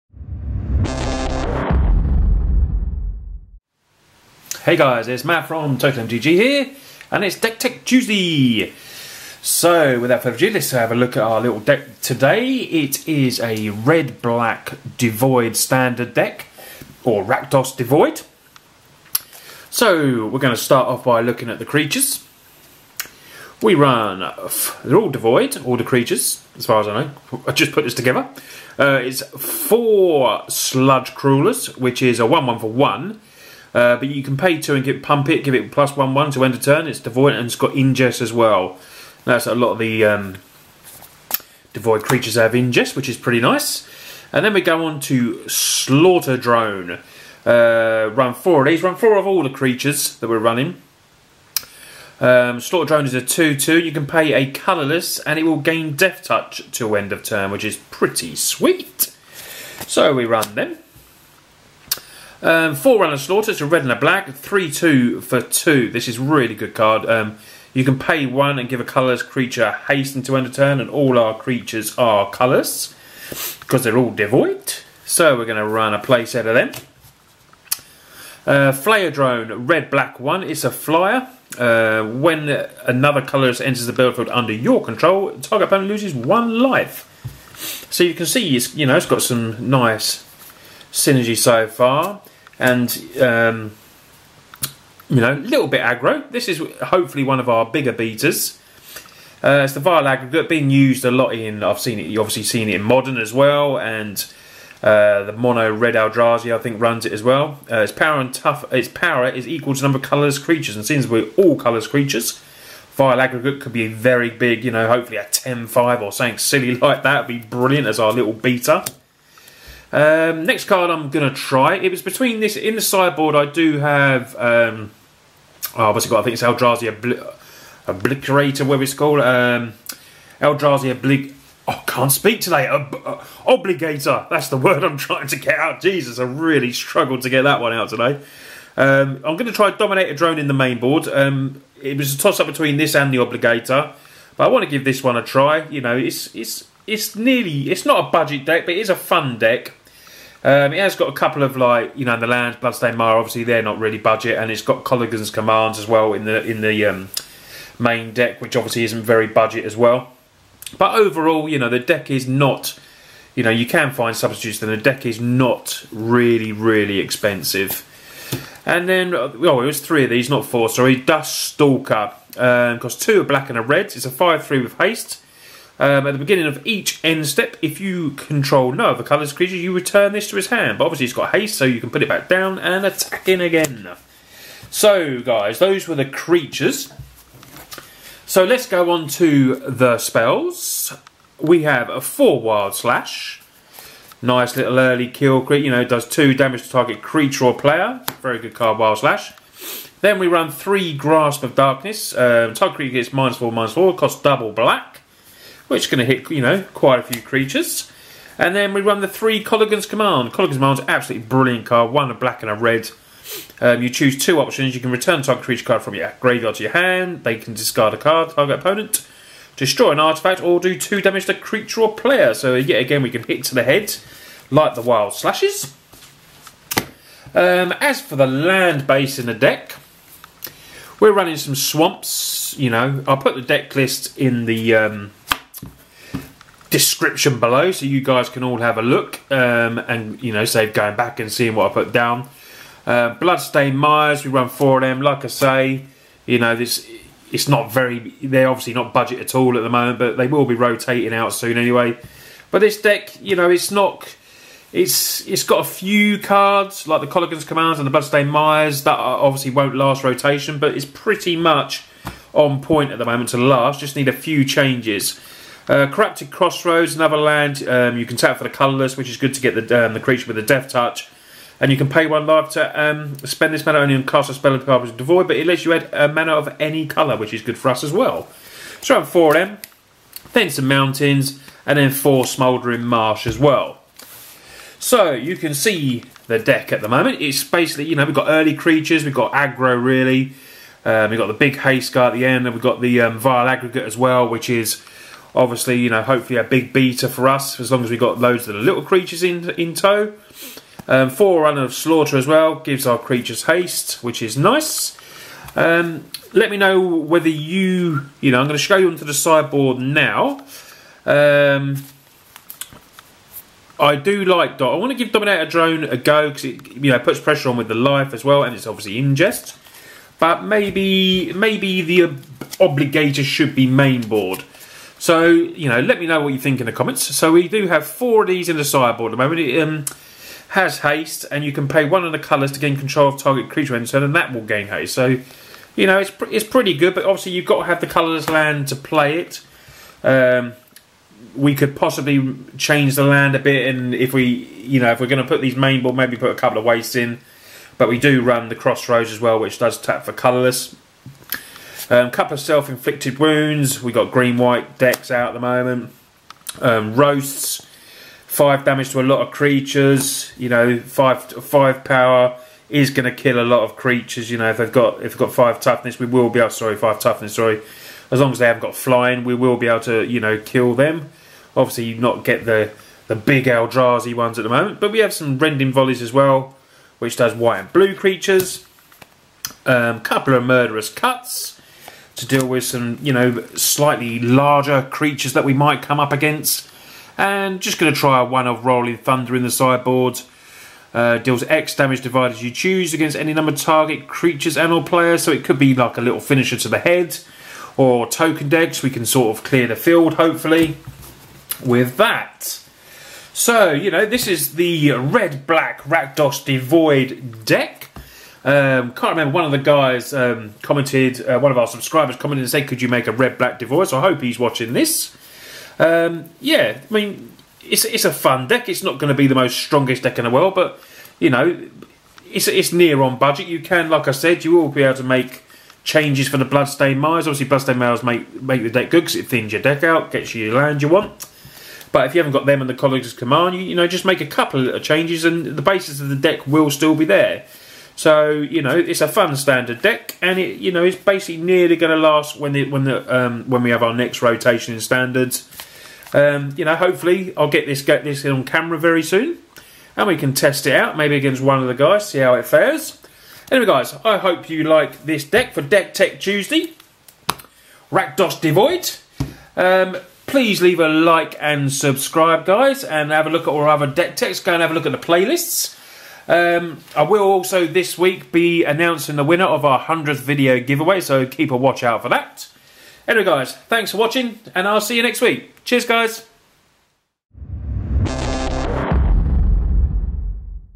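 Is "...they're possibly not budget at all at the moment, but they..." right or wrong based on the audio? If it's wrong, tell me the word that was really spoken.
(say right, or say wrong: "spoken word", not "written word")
wrong: "obviously", not "possibly".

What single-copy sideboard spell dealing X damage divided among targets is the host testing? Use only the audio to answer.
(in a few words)
Rolling Thunder.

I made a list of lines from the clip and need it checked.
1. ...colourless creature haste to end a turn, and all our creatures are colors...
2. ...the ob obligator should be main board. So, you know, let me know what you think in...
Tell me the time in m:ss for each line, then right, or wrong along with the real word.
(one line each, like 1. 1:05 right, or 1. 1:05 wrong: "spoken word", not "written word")
1. 1:08 right
2. 5:21 right.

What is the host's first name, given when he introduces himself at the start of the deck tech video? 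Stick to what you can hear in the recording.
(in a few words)
Matt.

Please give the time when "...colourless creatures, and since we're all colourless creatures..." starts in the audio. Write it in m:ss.
1:50.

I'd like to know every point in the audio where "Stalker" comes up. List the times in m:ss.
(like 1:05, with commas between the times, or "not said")
2:51.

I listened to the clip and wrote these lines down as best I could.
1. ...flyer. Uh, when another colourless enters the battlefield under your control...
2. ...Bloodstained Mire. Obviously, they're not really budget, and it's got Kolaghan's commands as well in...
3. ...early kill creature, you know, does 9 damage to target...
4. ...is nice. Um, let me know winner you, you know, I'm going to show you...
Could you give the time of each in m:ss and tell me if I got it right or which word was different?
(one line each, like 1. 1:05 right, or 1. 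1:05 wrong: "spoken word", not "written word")
1. 1:20 right
2. 2:32 right
3. 3:14 wrong: "2", not "9"
4. 5:04 wrong: "whether", not "winner".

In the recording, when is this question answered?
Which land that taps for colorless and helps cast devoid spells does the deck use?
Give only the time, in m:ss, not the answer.
4:25.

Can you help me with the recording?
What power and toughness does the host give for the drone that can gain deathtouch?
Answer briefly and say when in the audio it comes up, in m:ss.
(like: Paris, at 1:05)
2/2, at 0:53.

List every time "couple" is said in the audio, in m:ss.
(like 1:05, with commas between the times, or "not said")
2:31, 5:46, 5:52, 6:19, 7:14.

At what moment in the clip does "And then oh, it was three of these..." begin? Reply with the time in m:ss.
2:48.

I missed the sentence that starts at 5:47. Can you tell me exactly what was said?
But we do run the crossroads as well, which does tap for colourless.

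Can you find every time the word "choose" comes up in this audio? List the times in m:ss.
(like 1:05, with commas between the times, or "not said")
3:33, 6:32.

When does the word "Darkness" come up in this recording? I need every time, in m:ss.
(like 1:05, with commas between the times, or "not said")
3:21.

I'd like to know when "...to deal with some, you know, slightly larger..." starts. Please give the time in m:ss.
6:22.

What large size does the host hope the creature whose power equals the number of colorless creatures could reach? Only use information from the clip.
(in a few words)
10/5.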